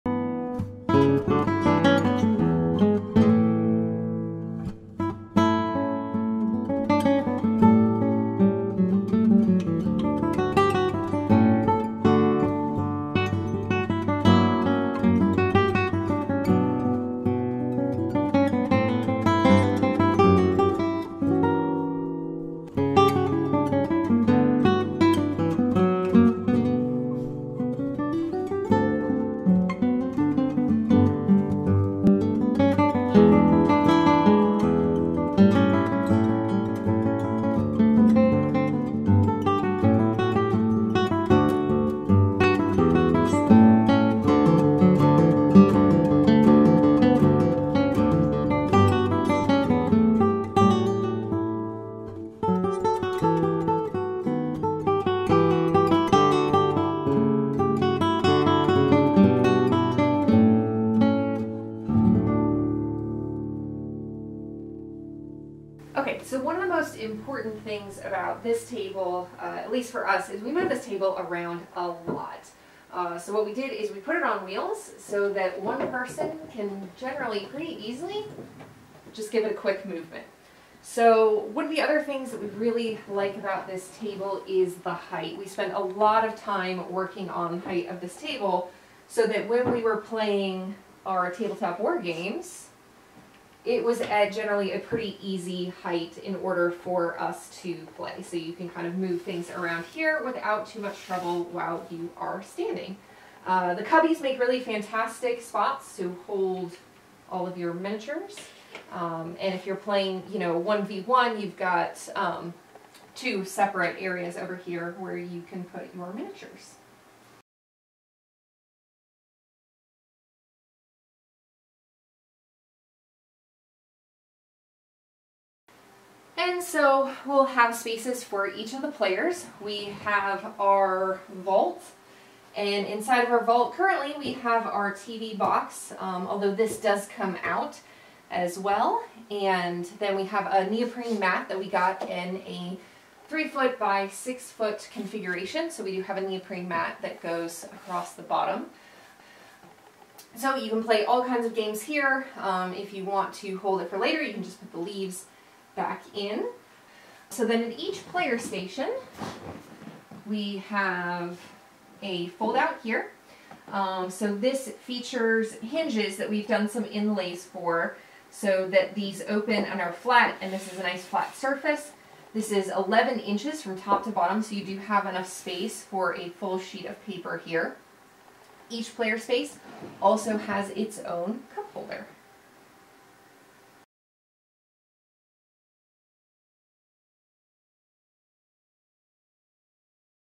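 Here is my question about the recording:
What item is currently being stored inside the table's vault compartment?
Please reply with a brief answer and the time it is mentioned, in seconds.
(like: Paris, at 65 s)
TV box, at 134 s.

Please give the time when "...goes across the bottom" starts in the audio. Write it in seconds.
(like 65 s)
147 s.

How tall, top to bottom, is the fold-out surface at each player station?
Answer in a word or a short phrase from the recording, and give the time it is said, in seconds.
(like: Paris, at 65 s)
11 inches, at 172 s.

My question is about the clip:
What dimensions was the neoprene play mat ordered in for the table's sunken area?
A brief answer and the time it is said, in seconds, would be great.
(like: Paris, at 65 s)
3 feet by 6 feet, at 143 s.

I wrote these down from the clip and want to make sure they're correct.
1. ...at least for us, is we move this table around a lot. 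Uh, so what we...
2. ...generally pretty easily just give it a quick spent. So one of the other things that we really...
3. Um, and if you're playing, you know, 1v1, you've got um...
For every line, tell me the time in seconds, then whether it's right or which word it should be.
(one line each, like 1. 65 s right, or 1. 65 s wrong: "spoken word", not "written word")
1. 69 s right
2. 76 s wrong: "movement", not "spent"
3. 108 s right.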